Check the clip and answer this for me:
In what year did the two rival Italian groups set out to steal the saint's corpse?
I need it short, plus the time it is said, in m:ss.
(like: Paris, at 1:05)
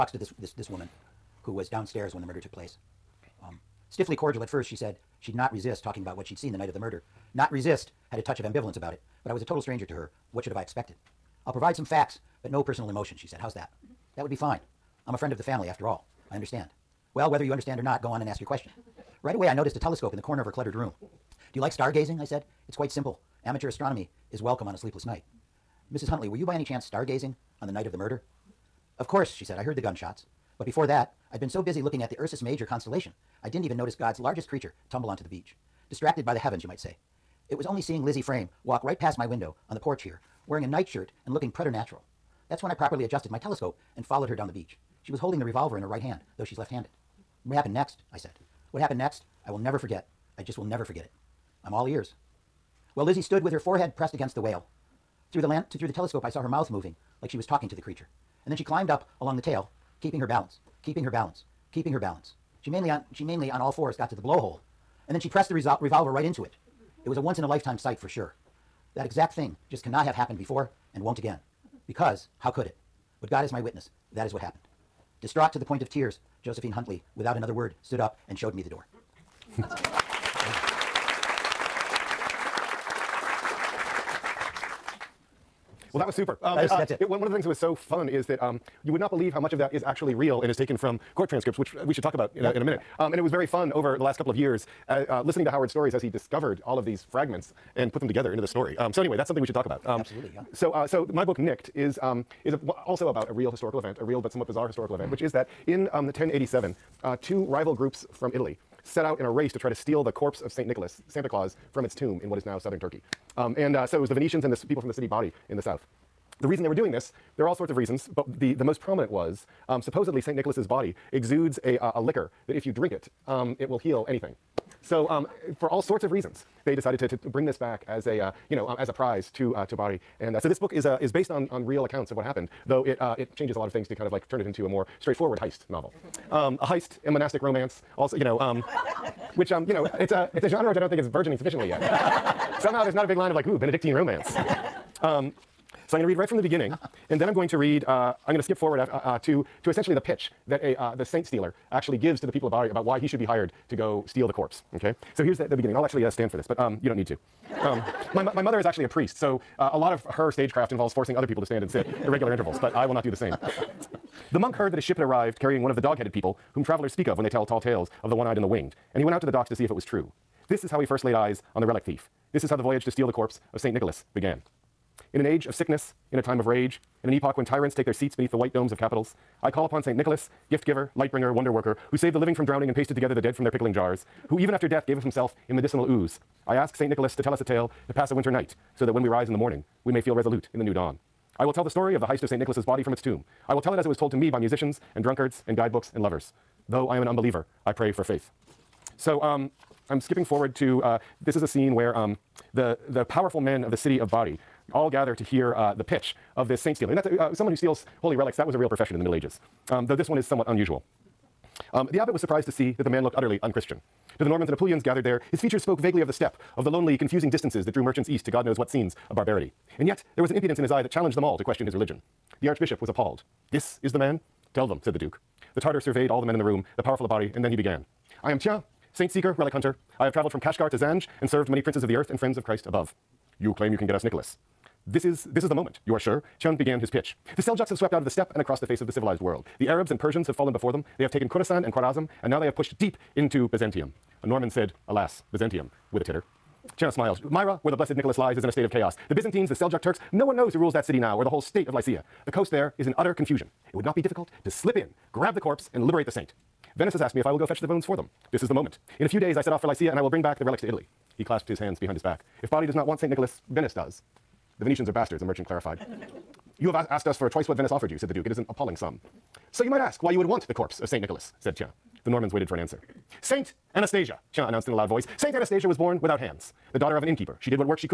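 1087, at 1:46.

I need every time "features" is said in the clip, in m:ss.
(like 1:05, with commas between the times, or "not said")
3:35.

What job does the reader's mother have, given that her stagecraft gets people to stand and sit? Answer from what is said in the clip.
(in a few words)
Priest.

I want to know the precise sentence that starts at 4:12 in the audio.
The coast there is in utter confusion.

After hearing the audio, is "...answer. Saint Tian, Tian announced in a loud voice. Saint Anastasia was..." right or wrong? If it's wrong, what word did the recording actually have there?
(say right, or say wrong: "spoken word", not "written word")
wrong: "Anastasia", not "Tian".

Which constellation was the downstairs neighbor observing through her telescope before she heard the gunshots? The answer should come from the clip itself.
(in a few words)
Ursus Major.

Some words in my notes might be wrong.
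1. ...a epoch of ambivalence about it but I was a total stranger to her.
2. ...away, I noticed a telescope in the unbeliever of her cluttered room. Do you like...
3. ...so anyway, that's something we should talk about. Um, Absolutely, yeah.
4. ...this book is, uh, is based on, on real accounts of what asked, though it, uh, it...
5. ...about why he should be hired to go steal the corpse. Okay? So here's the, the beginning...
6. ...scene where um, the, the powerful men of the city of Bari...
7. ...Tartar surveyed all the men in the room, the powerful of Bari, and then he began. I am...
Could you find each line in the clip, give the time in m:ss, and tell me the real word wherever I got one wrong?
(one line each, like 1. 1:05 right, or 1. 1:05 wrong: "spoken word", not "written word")
1. 0:08 wrong: "touch", not "epoch"
2. 0:19 wrong: "corner", not "unbeliever"
3. 1:38 right
4. 2:10 wrong: "happened", not "asked"
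5. 2:32 right
6. 3:21 right
7. 3:45 right.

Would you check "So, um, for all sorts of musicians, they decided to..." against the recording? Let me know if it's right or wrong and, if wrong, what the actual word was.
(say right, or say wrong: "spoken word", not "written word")
wrong: "reasons", not "musicians".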